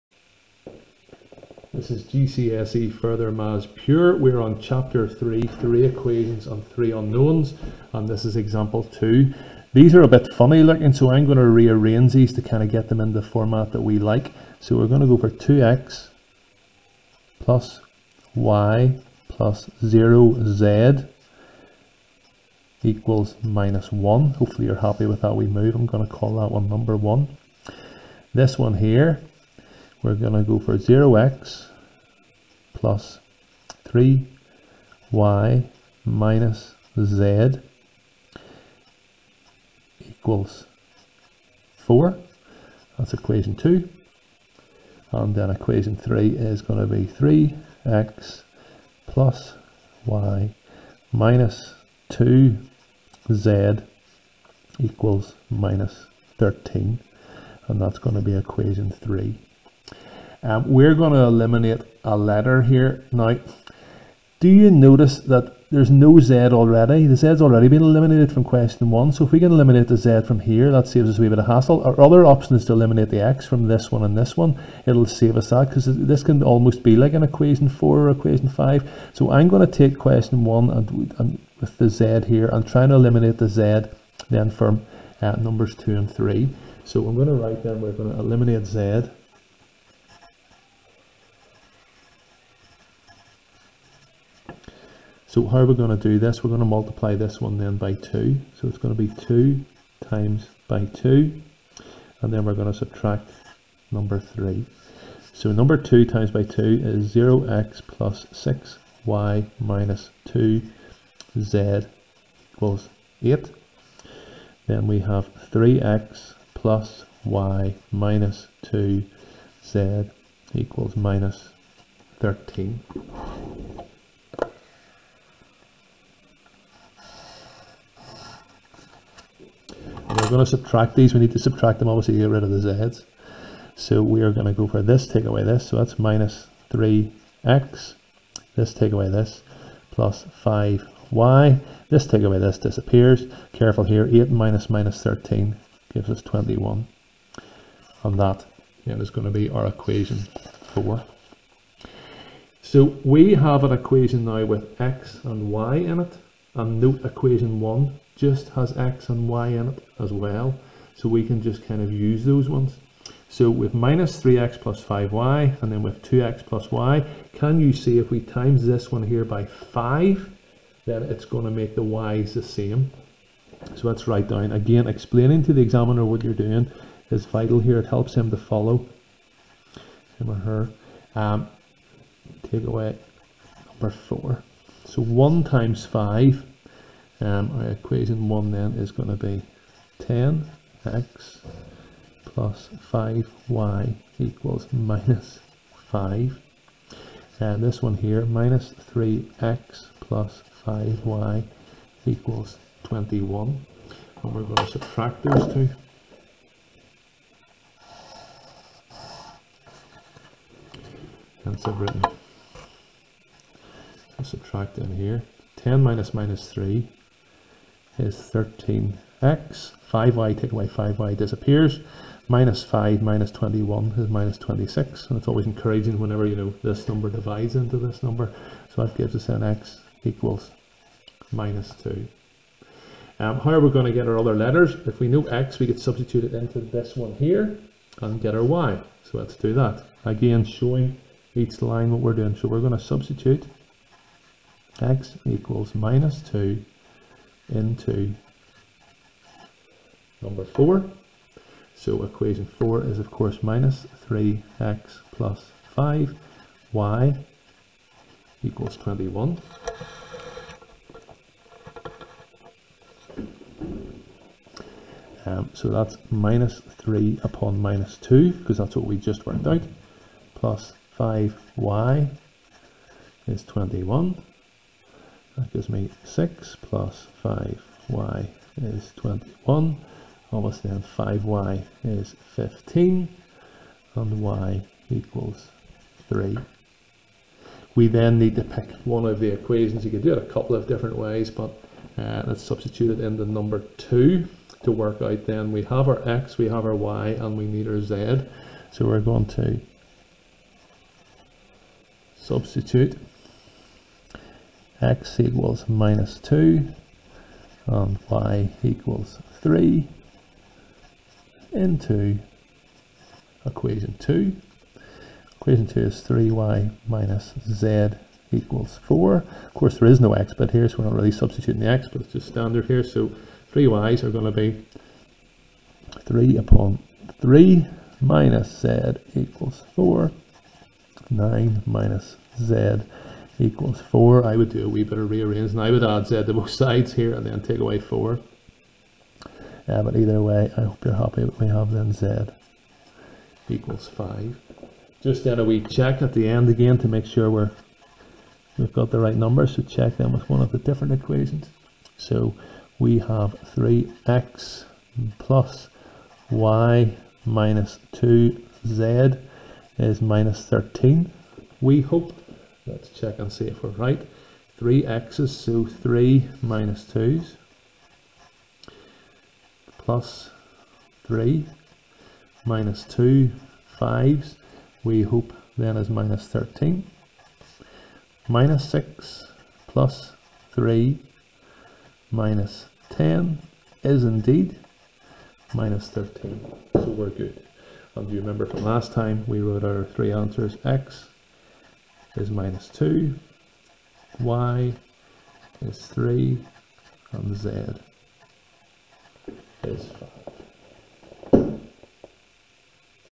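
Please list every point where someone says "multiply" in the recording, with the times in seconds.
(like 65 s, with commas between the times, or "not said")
96 s.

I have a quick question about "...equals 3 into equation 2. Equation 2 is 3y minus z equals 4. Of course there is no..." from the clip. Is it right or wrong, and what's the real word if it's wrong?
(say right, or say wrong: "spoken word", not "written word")
right.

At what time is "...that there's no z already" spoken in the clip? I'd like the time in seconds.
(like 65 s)
65 s.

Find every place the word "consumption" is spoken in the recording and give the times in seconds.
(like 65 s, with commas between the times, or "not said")
not said.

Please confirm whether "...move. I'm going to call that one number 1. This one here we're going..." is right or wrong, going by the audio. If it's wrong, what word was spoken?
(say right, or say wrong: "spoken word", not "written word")
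right.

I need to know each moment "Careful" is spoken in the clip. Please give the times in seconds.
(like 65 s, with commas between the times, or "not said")
143 s.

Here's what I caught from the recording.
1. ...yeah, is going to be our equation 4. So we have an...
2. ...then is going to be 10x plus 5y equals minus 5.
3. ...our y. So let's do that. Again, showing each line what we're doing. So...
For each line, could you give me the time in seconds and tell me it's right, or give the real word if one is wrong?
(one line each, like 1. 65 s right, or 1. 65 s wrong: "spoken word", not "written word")
1. 148 s right
2. 188 s right
3. 238 s right.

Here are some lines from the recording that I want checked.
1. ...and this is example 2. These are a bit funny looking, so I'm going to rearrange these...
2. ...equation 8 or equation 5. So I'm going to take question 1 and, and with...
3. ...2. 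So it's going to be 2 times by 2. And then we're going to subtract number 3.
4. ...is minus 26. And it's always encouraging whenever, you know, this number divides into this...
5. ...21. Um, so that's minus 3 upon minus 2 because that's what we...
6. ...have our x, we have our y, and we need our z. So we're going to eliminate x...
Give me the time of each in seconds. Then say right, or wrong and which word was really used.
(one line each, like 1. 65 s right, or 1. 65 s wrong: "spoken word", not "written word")
1. 7 s right
2. 77 s wrong: "4", not "8"
3. 97 s right
4. 223 s right
5. 258 s right
6. 295 s wrong: "substitute", not "eliminate".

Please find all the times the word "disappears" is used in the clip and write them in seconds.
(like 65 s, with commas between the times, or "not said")
142 s, 221 s.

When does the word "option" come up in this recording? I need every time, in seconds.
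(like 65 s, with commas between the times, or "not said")
72 s.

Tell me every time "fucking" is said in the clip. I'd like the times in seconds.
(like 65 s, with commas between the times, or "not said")
not said.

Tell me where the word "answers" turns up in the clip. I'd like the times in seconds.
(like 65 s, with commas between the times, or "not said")
390 s.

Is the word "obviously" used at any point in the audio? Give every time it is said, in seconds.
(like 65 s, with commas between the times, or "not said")
131 s, 280 s.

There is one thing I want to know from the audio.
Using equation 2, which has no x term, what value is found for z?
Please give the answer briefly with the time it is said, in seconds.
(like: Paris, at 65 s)
5, at 341 s.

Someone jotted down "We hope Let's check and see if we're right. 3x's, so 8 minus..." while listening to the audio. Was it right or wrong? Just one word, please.
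wrong.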